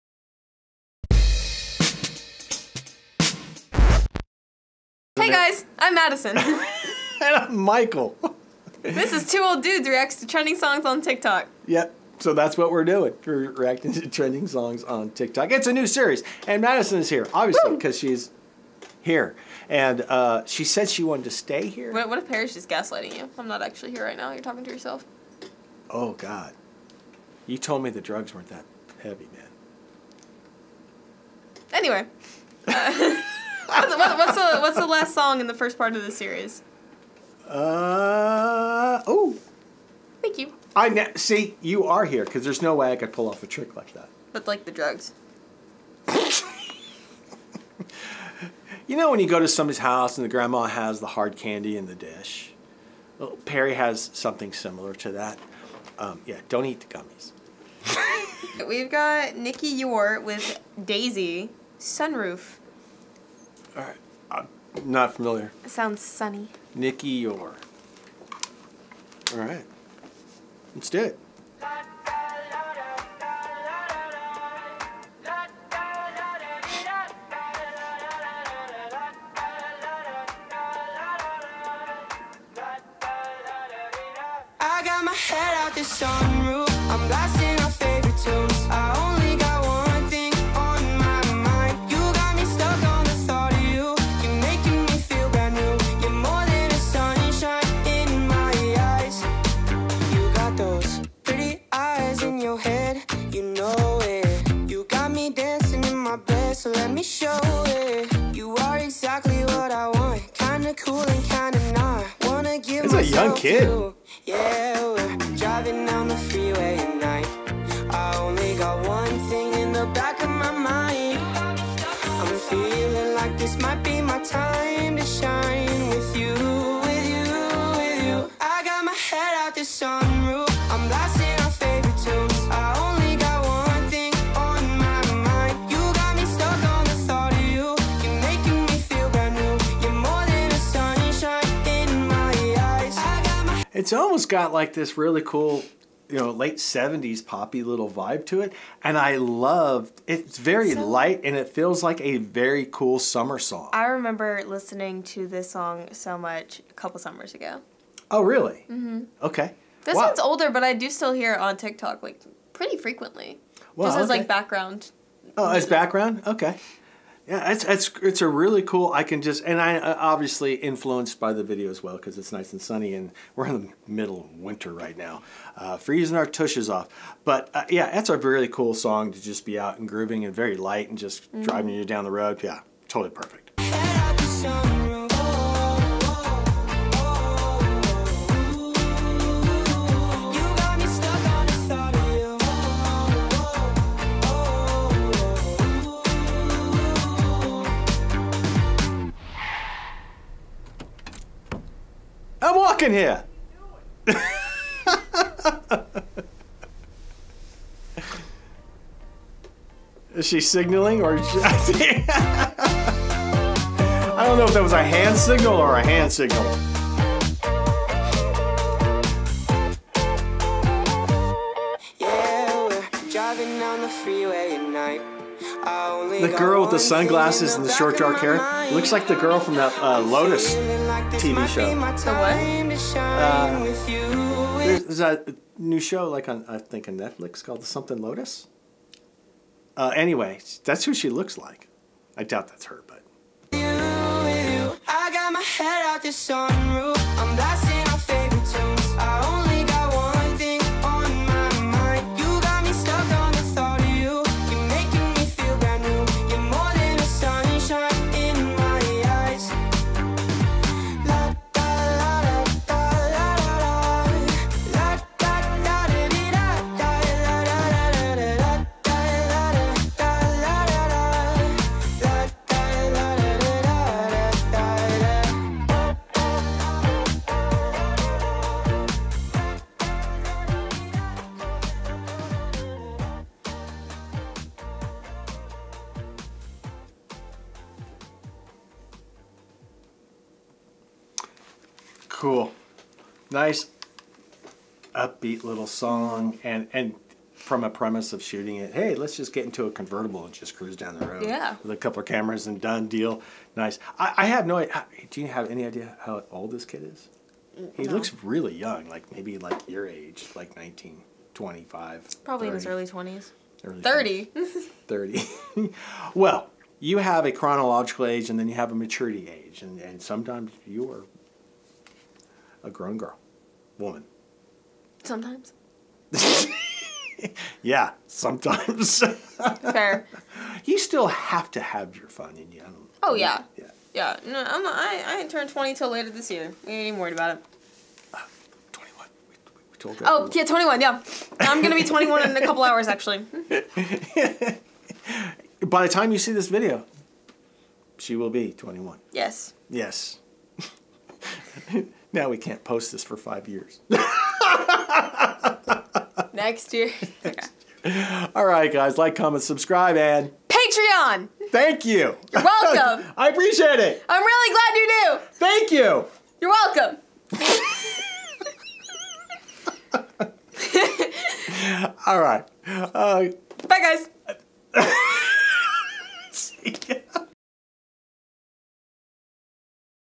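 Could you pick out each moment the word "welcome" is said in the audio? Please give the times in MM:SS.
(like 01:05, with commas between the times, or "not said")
06:02, 06:06.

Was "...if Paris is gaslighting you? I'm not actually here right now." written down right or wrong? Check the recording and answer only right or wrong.
right.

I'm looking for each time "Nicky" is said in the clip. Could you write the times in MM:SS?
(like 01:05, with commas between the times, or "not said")
00:59, 01:06.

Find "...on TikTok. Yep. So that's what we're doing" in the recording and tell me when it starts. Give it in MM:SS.
00:10.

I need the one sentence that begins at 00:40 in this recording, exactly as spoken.
I ne- see you are here because there's no way I could pull off a trick like that.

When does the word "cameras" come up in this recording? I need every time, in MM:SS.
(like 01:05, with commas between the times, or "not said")
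05:02.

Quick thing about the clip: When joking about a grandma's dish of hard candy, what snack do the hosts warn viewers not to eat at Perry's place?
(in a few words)
gummies.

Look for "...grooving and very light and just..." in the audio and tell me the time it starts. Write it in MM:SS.
02:59.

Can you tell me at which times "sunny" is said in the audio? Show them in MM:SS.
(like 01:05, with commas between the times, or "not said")
01:06, 02:52.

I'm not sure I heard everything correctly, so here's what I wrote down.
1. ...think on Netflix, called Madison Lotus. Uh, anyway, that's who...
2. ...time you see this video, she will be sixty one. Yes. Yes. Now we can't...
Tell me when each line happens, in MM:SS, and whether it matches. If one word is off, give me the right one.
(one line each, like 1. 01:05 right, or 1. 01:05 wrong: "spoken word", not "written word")
1. 03:56 wrong: "Something", not "Madison"
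2. 05:45 wrong: "twenty", not "sixty".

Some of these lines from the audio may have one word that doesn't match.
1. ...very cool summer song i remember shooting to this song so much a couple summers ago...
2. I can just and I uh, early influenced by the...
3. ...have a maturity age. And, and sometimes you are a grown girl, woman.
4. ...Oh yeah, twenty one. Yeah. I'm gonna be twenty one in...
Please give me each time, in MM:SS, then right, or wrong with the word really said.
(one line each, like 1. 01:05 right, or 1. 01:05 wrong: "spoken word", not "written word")
1. 02:32 wrong: "listening", not "shooting"
2. 02:48 wrong: "obviously", not "early"
3. 05:18 right
4. 05:40 right.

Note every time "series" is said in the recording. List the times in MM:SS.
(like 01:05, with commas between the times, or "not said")
00:15, 00:36.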